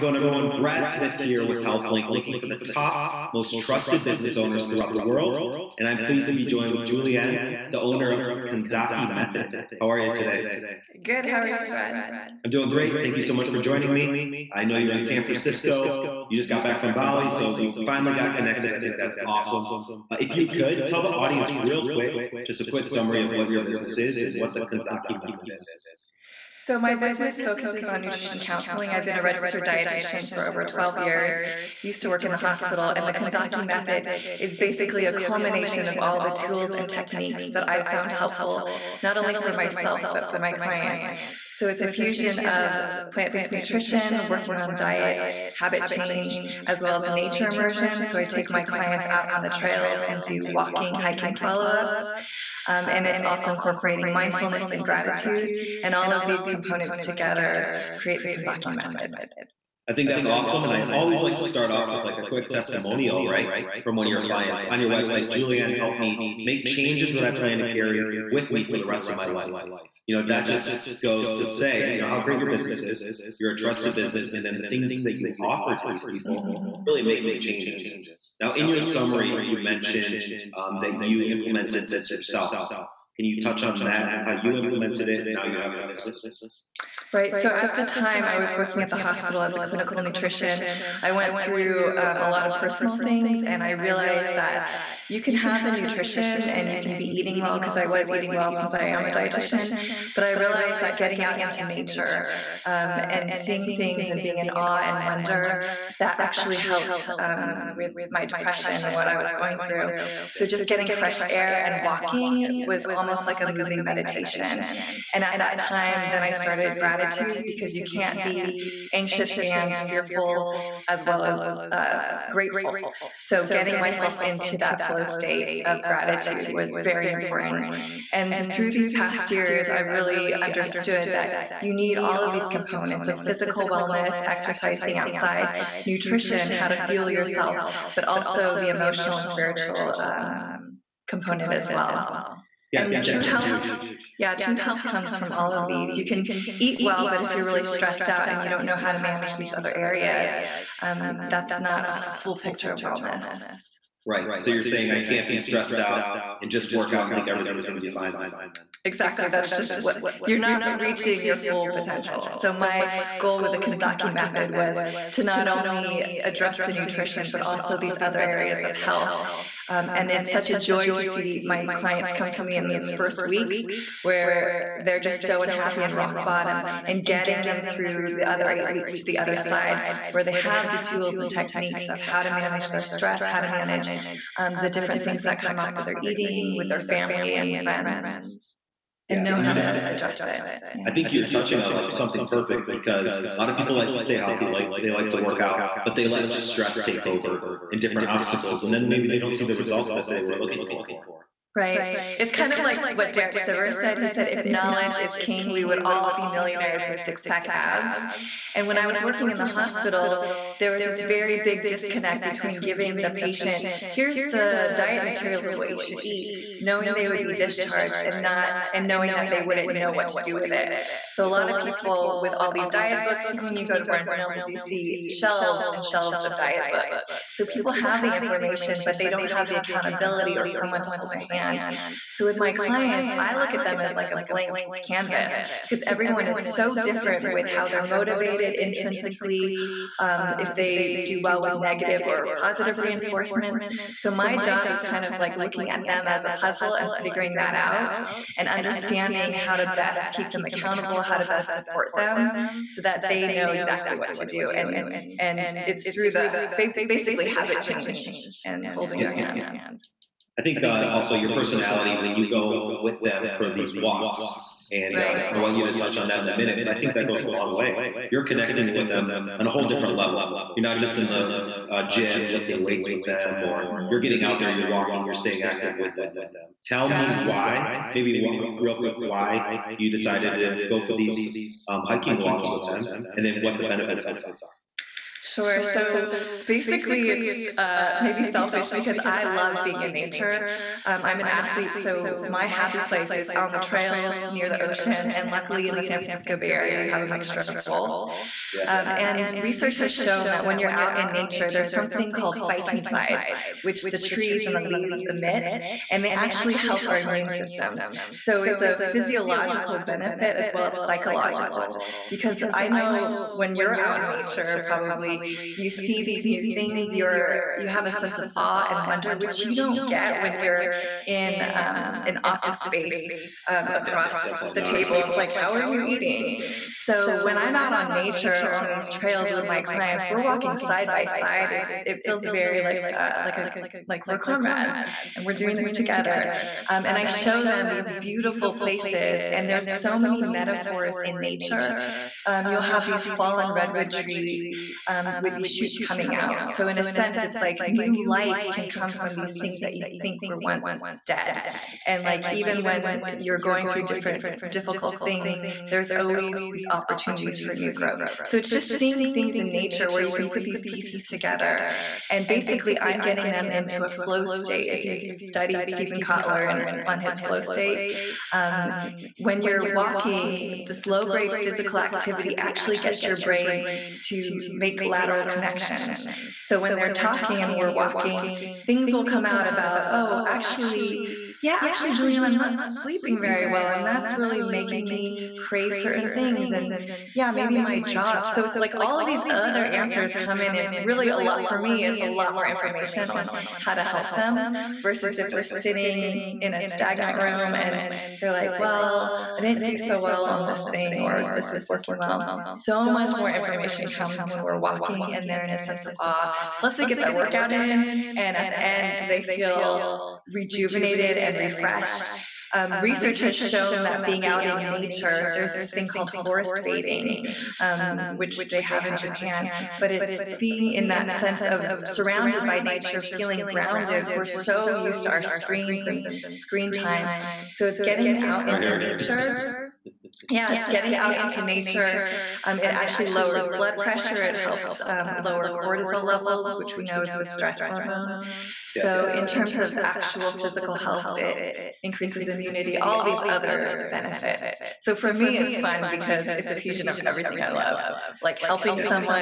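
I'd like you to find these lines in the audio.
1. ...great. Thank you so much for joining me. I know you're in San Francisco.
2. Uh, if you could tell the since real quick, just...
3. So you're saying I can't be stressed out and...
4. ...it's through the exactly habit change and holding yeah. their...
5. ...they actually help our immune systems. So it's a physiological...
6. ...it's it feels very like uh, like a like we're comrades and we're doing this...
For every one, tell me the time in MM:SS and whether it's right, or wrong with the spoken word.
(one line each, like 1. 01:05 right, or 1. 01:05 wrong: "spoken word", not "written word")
1. 00:12 right
2. 00:20 wrong: "audience", not "since"
3. 02:34 right
4. 04:15 wrong: "basically", not "exactly"
5. 05:06 right
6. 05:31 right.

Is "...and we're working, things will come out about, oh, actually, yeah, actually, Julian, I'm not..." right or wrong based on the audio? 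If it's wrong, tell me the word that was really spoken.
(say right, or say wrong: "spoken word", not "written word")
wrong: "walking", not "working".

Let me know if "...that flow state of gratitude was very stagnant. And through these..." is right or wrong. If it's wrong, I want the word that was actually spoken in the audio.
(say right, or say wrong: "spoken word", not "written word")
wrong: "important", not "stagnant".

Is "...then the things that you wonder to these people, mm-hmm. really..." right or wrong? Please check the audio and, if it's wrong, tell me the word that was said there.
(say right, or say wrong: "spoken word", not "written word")
wrong: "offer", not "wonder".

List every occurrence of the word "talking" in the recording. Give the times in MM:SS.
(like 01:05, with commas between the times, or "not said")
06:16.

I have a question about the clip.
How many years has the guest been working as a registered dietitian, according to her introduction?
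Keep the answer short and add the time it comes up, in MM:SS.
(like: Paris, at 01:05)
12, at 00:30.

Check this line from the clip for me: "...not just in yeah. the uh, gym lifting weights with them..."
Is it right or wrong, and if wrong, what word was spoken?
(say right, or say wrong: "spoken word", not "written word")
right.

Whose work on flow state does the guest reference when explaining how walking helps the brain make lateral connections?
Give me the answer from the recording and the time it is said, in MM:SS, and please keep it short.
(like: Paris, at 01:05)
Steven Kotler, at 06:05.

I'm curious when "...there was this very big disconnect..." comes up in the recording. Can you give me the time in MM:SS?
03:30.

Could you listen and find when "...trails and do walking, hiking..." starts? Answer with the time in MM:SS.
00:49.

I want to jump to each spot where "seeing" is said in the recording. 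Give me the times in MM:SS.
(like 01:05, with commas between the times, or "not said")
01:43, 05:58.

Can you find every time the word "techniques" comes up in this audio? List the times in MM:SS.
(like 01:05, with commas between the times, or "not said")
00:36, 03:01.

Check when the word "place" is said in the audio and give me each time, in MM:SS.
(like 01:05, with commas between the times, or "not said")
04:52, 05:38.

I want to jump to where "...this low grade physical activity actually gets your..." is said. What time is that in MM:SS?
06:10.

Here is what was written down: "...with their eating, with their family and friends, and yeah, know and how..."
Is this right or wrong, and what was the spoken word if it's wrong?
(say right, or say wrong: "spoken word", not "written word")
right.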